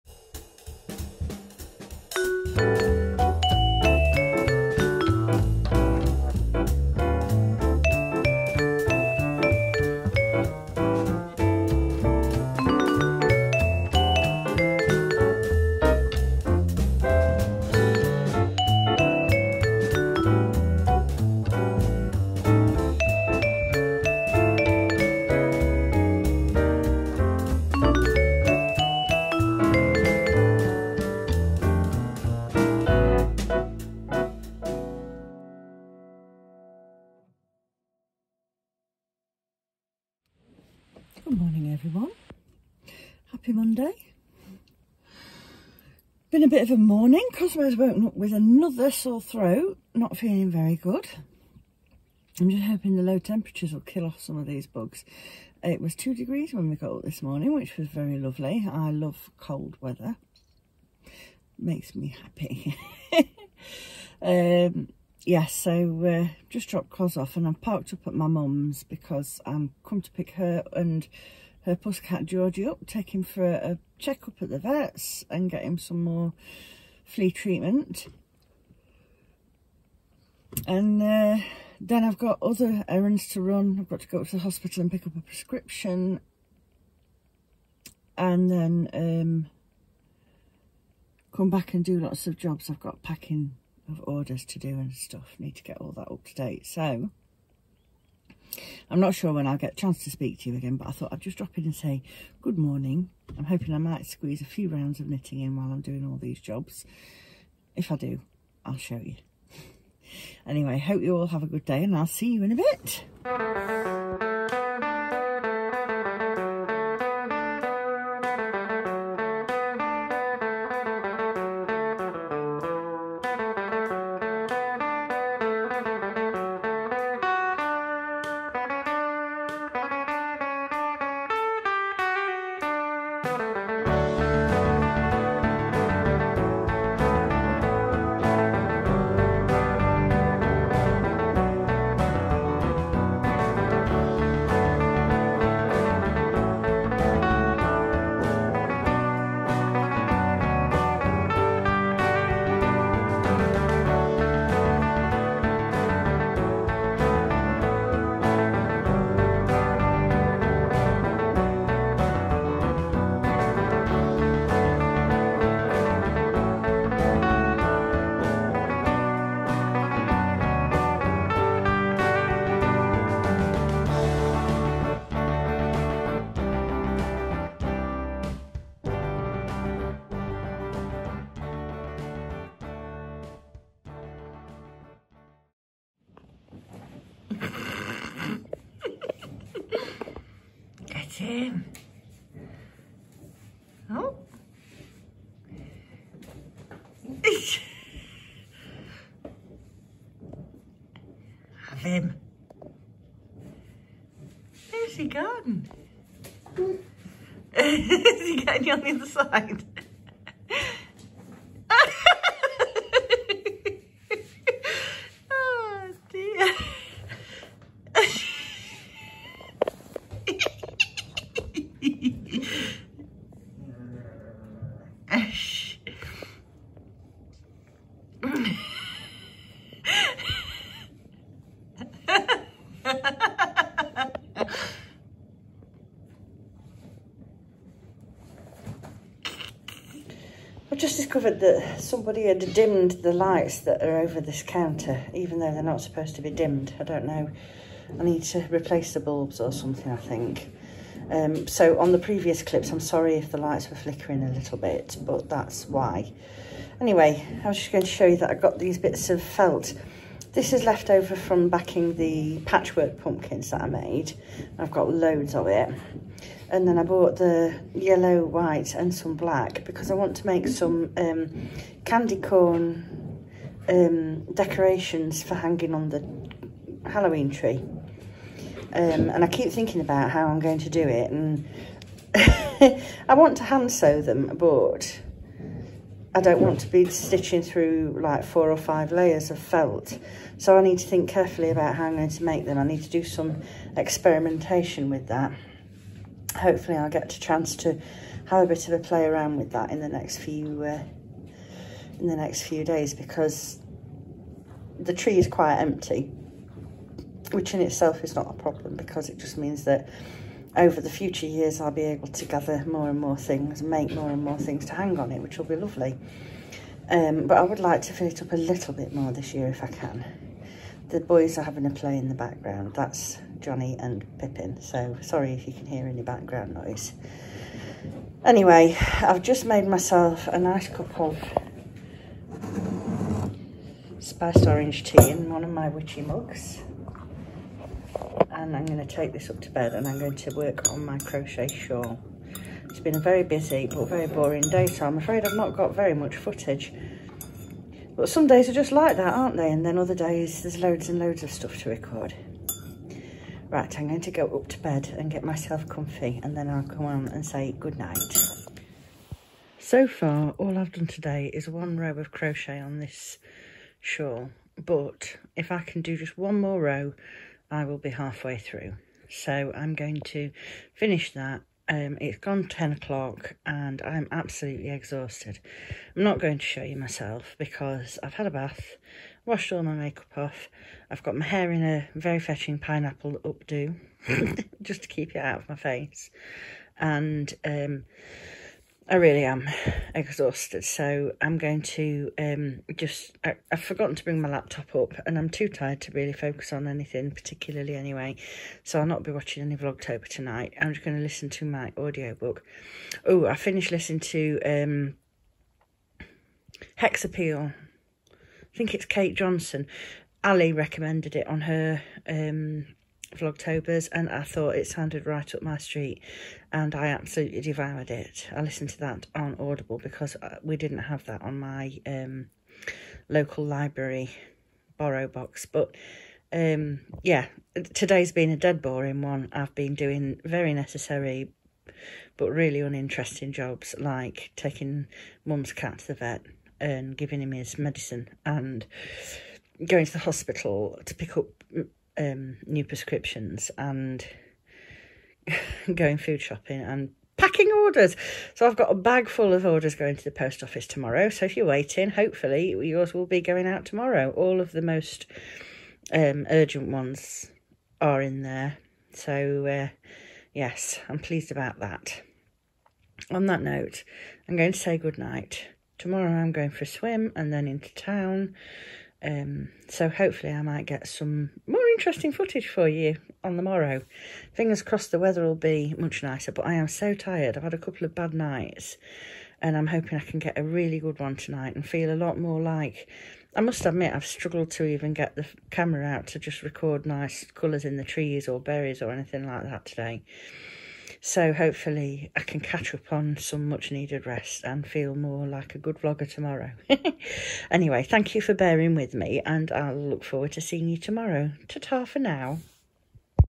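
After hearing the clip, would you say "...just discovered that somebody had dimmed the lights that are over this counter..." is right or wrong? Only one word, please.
right.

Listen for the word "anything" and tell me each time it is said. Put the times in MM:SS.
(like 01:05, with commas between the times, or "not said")
06:36, 08:08.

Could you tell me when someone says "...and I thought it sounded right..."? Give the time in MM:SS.
06:53.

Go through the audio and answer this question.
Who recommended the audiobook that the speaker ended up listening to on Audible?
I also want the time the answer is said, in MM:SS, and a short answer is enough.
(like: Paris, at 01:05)
Ali, at 06:50.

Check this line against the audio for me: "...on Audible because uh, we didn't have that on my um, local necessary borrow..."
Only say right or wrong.
wrong.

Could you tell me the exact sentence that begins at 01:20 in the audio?
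And uh, then I've got other errands to run.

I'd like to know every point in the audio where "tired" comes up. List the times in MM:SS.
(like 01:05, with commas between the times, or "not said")
06:35, 07:56.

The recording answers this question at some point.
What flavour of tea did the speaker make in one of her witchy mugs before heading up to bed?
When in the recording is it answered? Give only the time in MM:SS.
05:33.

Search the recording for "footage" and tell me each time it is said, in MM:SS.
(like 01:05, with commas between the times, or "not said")
05:46, 07:52.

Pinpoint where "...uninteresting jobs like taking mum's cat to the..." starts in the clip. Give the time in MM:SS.
07:12.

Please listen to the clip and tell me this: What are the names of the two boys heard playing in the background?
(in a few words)
Johnny and Pippin.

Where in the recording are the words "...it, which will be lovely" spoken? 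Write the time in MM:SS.
05:15.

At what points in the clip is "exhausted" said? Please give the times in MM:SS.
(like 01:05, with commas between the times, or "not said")
06:14, 06:29.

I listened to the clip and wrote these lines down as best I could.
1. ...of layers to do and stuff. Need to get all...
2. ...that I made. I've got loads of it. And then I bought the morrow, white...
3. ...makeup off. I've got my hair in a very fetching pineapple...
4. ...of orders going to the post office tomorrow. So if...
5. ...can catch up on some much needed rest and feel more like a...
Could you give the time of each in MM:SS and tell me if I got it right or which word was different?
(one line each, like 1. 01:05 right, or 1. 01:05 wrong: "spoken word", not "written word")
1. 01:33 wrong: "orders", not "layers"
2. 04:23 wrong: "yellow", not "morrow"
3. 06:19 right
4. 07:29 right
5. 08:12 right.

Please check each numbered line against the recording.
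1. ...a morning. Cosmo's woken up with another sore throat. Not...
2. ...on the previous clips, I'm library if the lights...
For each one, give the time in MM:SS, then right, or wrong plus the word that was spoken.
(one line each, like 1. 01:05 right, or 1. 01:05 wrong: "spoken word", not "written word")
1. 00:46 right
2. 04:11 wrong: "sorry", not "library".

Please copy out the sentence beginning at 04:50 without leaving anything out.
So I need to think carefully about how I'm going to make them.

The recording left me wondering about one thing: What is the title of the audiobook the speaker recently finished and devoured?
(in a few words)
Hex Appeal.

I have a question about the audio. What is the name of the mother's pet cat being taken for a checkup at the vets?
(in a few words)
Georgie.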